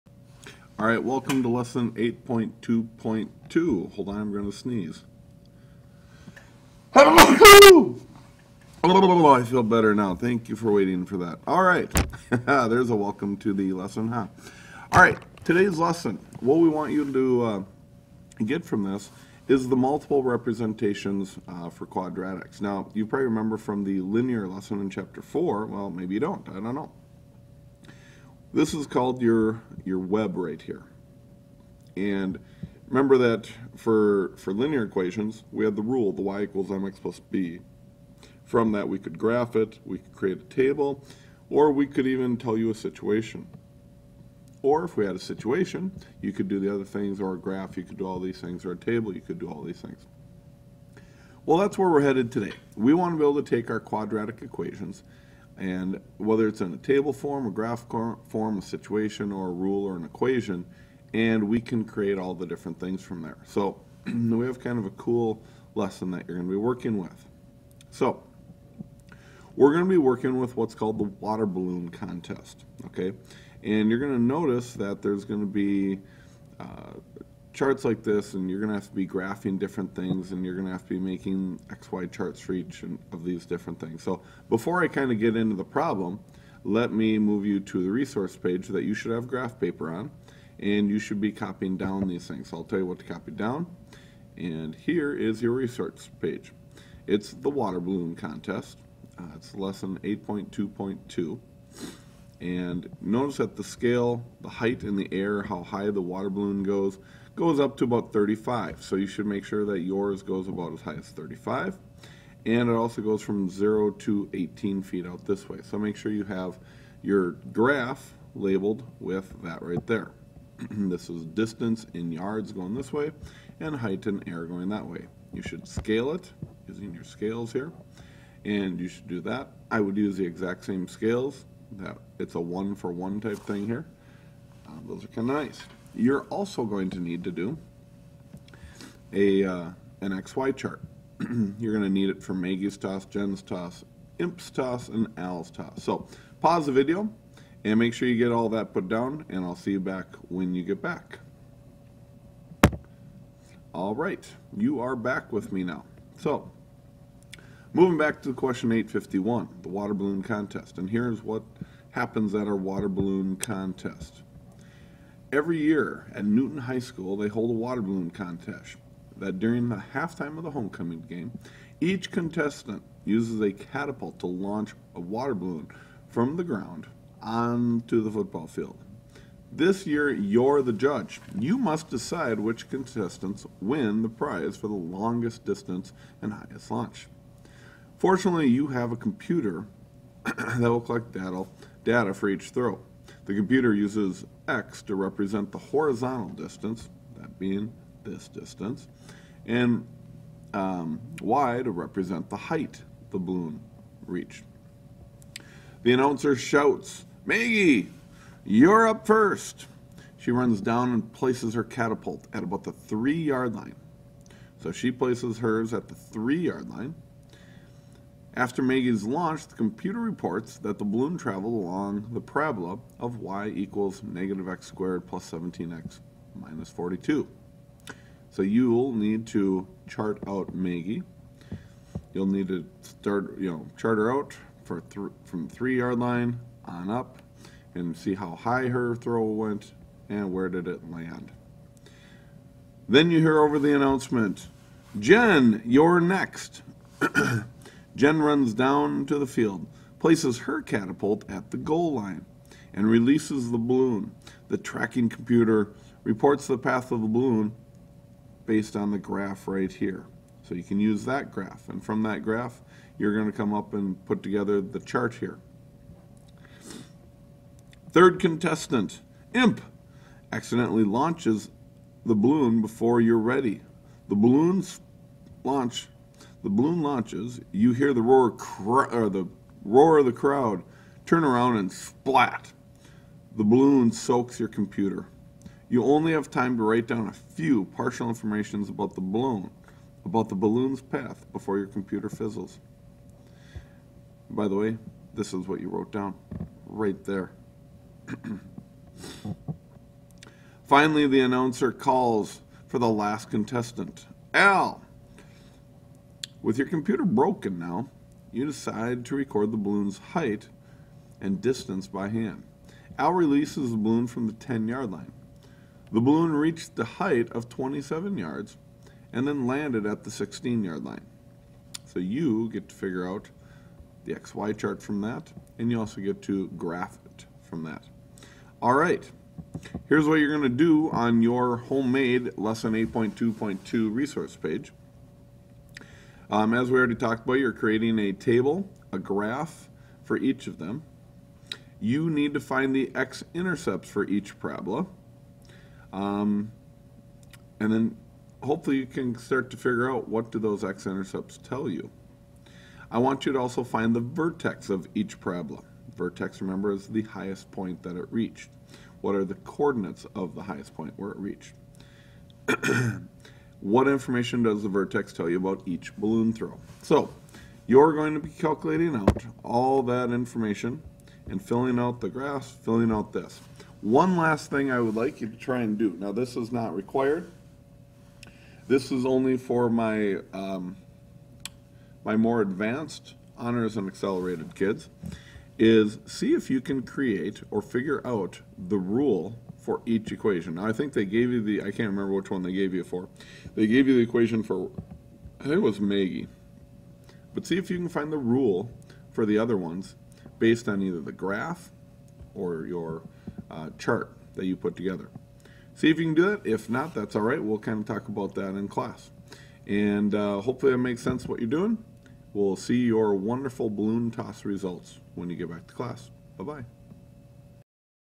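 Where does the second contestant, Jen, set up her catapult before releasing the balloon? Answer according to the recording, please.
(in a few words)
the goal line.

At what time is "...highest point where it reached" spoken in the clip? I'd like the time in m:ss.
6:00.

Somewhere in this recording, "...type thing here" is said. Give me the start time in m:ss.
2:13.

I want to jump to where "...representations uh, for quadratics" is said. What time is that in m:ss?
0:20.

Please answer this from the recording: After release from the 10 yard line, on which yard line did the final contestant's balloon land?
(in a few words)
16 yard line.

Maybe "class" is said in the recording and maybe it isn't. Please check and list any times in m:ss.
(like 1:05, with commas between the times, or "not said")
6:48, 6:55.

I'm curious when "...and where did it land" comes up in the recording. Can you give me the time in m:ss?
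4:00.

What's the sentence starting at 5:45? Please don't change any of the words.
Um, and then hopefully you can start to figure out what do those x-intercepts tell you.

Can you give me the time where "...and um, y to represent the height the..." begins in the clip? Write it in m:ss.
3:19.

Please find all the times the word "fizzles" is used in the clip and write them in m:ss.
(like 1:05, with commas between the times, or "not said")
4:52.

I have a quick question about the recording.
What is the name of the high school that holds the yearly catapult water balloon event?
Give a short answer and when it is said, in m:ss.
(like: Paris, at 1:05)
Newton High School, at 2:46.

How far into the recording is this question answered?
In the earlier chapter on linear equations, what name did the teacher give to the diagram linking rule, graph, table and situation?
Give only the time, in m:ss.
0:29.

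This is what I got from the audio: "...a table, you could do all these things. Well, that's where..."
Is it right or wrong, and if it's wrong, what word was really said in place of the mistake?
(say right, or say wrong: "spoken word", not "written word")
right.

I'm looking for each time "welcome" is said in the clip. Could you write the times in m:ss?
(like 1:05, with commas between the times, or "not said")
0:01, 0:12.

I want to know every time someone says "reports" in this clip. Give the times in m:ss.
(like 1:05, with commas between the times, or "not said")
3:39, 4:16.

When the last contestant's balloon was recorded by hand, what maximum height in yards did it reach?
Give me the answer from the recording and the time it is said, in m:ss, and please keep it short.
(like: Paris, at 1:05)
27, at 5:17.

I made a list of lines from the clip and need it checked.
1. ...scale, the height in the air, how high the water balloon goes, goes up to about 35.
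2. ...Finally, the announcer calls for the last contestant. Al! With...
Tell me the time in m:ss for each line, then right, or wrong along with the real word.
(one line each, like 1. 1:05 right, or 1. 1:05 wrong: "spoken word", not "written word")
1. 1:43 right
2. 5:00 right.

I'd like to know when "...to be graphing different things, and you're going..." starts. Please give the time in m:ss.
1:18.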